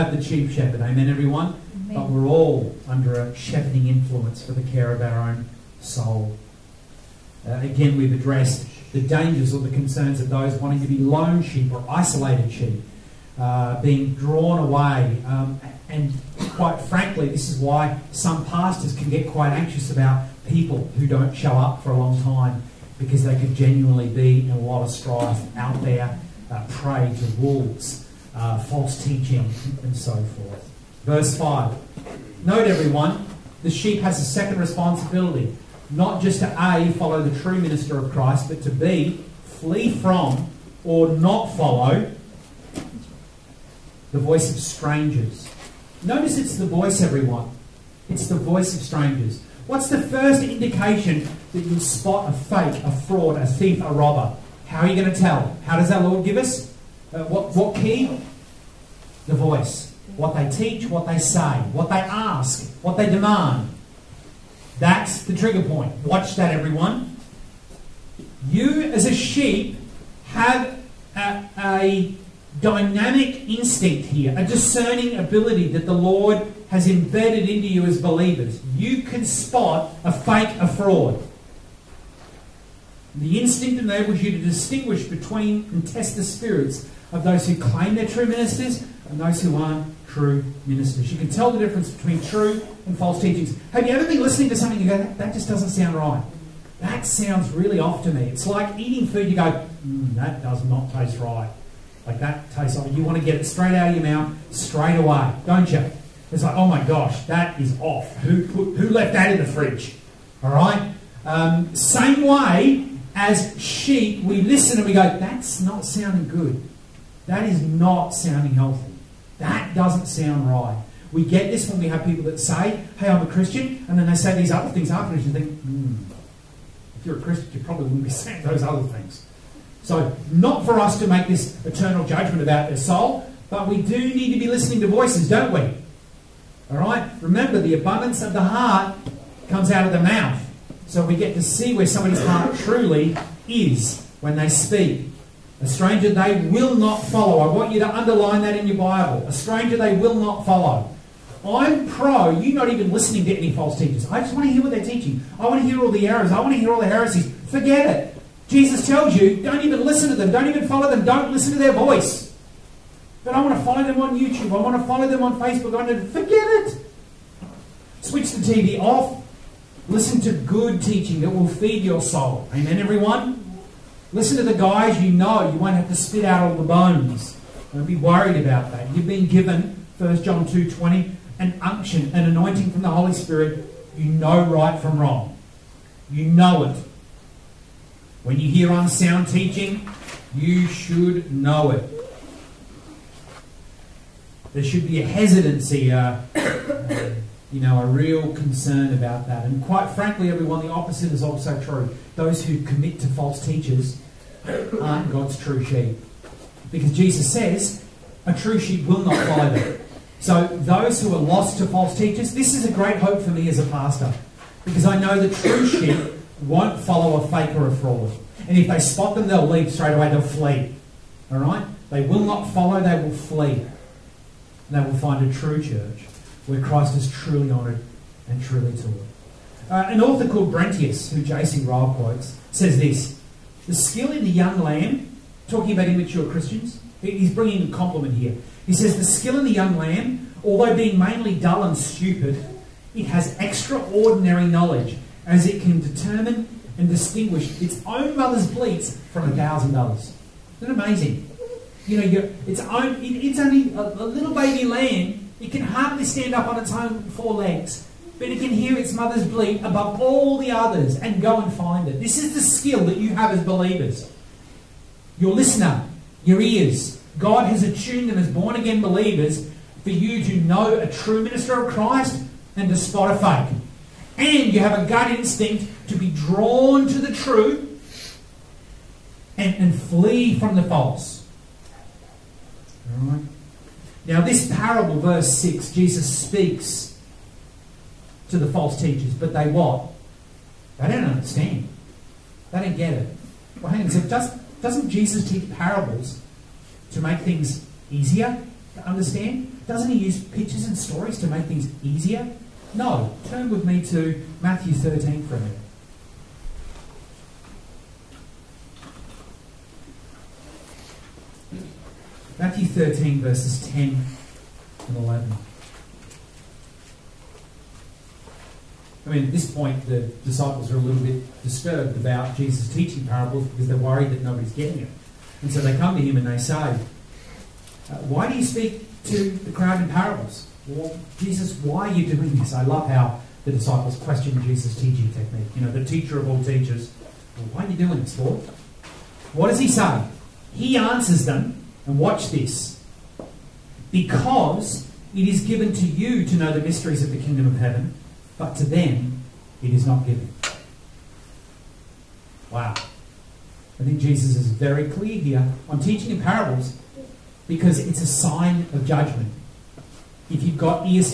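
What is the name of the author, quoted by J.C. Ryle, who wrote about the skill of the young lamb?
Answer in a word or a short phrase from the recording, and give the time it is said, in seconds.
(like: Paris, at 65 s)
Brentius, at 230 s.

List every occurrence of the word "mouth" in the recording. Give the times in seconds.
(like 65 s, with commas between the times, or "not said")
104 s, 139 s.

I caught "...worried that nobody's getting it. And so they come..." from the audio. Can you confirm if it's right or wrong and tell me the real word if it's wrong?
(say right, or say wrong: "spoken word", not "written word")
right.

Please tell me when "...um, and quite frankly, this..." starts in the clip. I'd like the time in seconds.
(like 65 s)
15 s.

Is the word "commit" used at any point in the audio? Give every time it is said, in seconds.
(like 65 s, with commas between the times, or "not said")
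202 s.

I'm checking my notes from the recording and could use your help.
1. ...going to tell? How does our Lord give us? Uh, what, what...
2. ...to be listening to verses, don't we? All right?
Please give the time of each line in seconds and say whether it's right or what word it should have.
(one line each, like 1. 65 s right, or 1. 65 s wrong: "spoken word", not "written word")
1. 54 s right
2. 134 s wrong: "voices", not "verses".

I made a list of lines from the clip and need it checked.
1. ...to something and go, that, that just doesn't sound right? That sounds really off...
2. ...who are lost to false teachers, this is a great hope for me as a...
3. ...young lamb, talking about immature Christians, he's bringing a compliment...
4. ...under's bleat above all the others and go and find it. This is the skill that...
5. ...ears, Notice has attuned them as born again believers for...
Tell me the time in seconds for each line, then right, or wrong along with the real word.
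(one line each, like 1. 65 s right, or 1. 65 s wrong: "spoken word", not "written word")
1. 94 s right
2. 211 s right
3. 234 s right
4. 258 s wrong: "mother", not "under"
5. 266 s wrong: "God", not "Notice".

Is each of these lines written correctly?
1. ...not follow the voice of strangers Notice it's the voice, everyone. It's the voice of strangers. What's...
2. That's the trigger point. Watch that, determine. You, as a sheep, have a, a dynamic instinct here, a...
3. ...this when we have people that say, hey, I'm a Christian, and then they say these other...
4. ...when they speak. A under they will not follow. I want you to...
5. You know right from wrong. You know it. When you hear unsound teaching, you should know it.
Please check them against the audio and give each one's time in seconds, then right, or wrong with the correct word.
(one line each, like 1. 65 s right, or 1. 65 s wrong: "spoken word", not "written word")
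1. 41 s right
2. 64 s wrong: "everyone", not "determine"
3. 121 s right
4. 144 s wrong: "stranger", not "under"
5. 183 s right.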